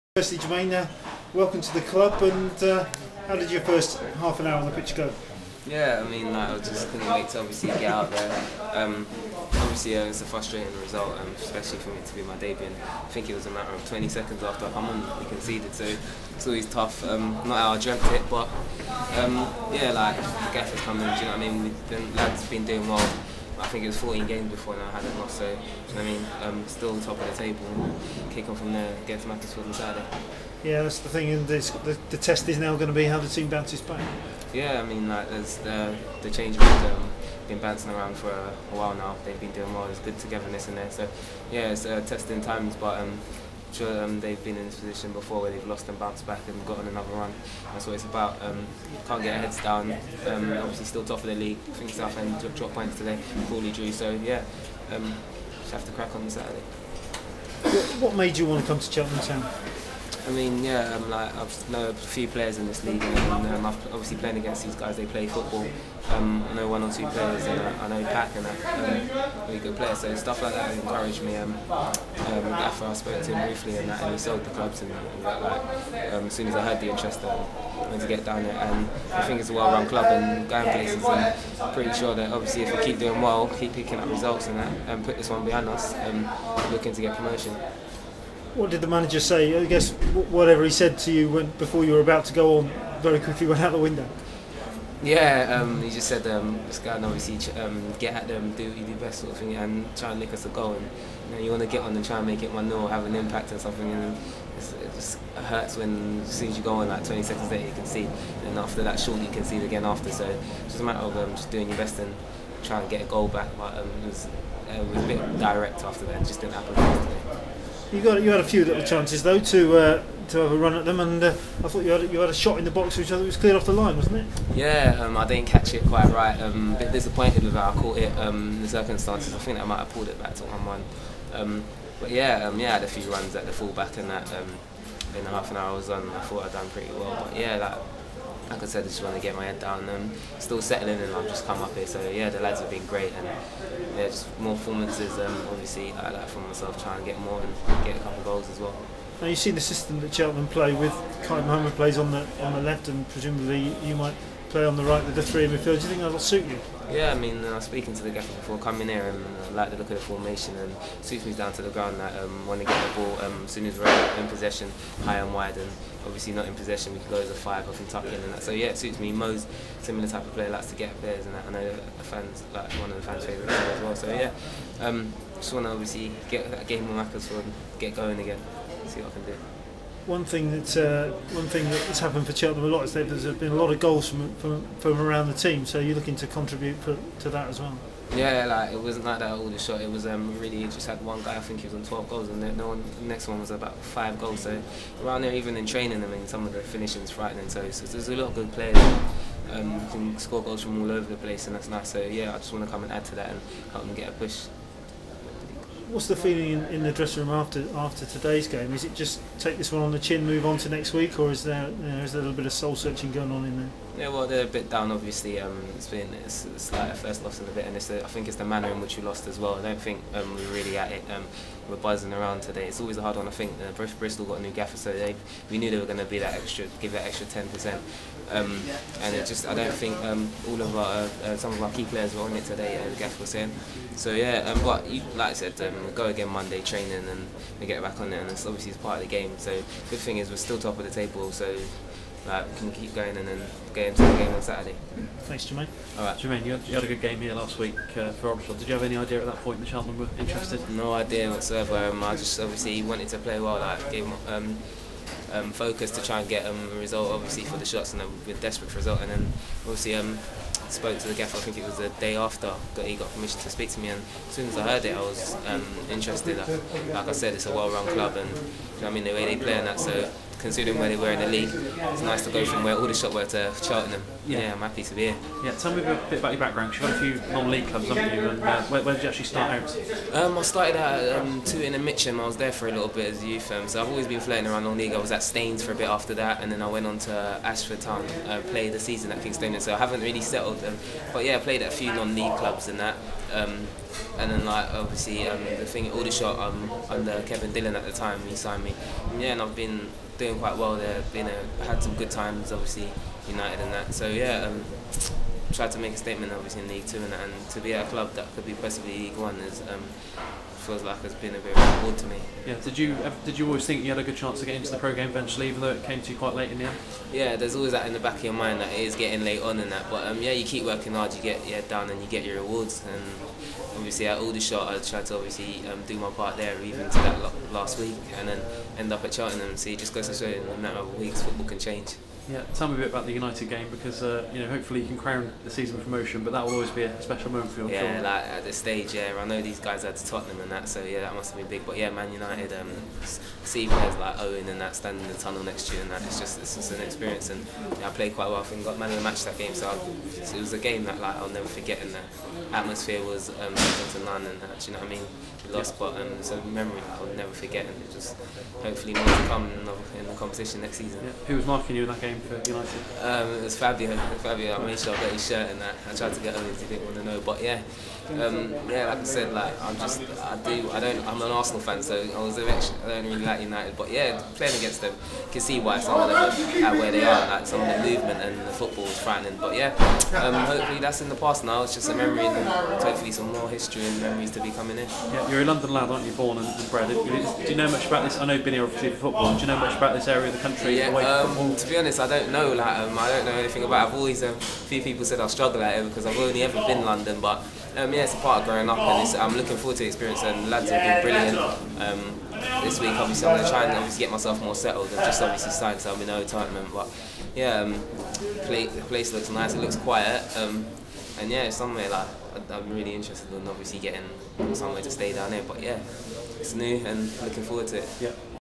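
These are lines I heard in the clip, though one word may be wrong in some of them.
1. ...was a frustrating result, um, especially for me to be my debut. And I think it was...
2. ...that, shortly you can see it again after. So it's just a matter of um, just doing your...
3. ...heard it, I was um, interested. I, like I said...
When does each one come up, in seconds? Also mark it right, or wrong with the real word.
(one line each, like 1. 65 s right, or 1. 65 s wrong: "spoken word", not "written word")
1. 10 s right
2. 108 s right
3. 264 s right.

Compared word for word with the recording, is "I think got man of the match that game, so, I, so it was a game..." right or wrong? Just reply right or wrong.
right.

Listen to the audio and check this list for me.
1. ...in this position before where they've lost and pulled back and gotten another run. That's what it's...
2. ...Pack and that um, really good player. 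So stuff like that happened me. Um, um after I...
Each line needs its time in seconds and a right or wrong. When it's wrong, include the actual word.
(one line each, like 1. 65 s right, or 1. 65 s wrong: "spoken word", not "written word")
1. 44 s wrong: "bounced", not "pulled"
2. 68 s wrong: "encouraged", not "happened".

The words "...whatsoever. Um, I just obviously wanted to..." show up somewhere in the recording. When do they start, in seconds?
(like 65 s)
251 s.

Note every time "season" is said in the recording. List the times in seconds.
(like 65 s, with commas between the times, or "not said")
288 s, 335 s, 360 s.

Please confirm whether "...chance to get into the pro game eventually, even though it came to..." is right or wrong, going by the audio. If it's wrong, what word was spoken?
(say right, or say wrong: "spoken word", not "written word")
right.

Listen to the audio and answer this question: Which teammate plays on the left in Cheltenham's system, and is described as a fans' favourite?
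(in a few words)
Kaid Mohamed.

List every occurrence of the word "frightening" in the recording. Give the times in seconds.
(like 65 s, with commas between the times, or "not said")
197 s, 378 s.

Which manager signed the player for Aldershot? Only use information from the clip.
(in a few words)
Kevin Dillon.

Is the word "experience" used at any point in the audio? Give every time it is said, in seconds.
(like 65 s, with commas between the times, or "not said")
346 s, 399 s.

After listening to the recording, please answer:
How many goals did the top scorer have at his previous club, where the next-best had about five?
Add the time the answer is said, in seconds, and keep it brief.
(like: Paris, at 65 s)
12, at 191 s.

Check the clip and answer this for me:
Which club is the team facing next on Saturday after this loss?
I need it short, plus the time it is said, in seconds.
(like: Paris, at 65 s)
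Macclesfield, at 29 s.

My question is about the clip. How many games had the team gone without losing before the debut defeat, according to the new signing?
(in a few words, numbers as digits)
14.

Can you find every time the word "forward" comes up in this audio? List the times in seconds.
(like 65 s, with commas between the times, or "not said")
399 s, 417 s.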